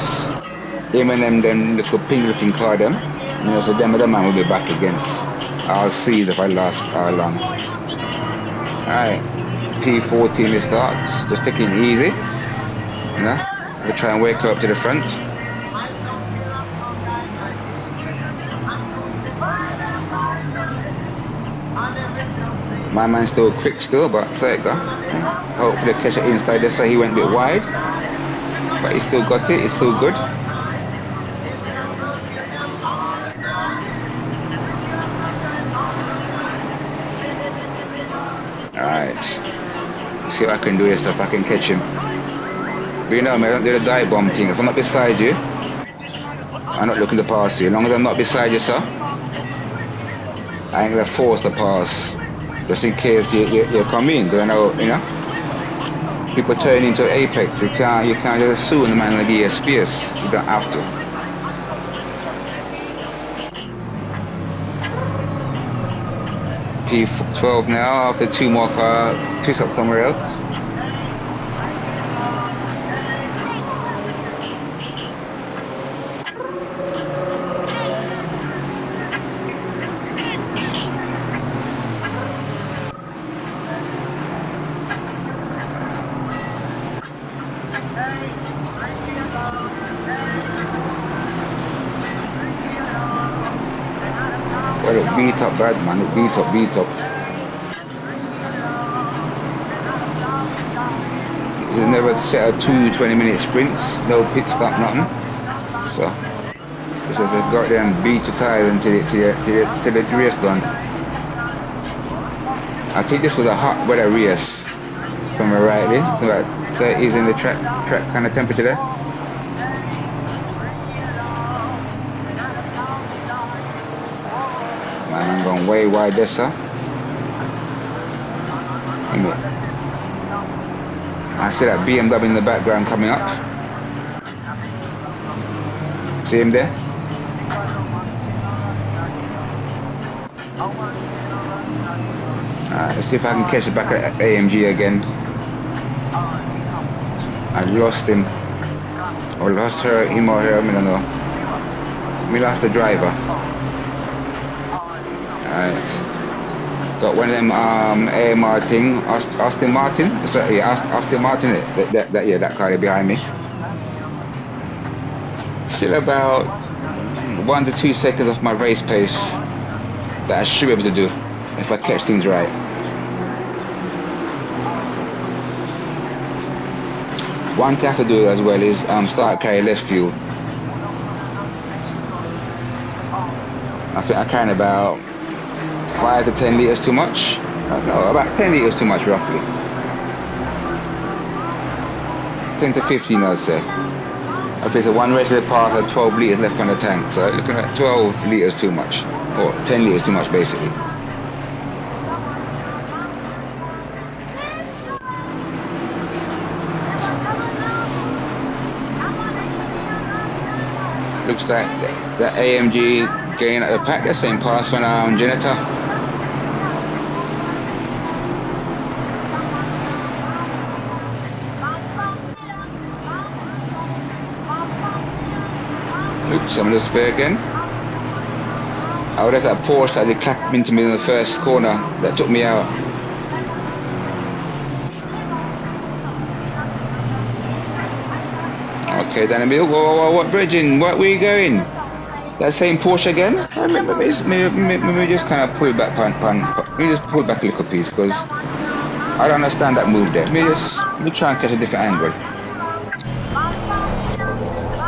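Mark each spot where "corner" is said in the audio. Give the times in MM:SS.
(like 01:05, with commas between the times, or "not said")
03:51.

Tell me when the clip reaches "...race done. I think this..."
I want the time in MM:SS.
01:50.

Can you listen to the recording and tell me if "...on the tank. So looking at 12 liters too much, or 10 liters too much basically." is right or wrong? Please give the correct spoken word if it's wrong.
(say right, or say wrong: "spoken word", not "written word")
right.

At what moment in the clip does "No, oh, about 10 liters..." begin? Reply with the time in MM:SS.
03:07.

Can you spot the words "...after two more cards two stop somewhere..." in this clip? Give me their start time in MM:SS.
01:08.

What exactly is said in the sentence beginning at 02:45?
Still about one to two seconds off my race pace that I should be able to do if I catch things right.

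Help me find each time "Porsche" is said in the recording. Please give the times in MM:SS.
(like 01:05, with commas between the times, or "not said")
03:49, 04:02.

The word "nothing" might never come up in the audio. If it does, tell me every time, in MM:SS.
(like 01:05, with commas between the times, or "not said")
01:44.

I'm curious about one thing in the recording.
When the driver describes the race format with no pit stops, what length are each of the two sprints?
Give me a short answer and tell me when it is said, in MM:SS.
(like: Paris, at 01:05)
20 minutes, at 01:42.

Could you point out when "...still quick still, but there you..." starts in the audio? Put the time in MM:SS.
00:23.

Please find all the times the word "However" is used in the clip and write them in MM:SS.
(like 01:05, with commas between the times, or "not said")
03:49.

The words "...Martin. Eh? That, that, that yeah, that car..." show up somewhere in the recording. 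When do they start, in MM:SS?
02:41.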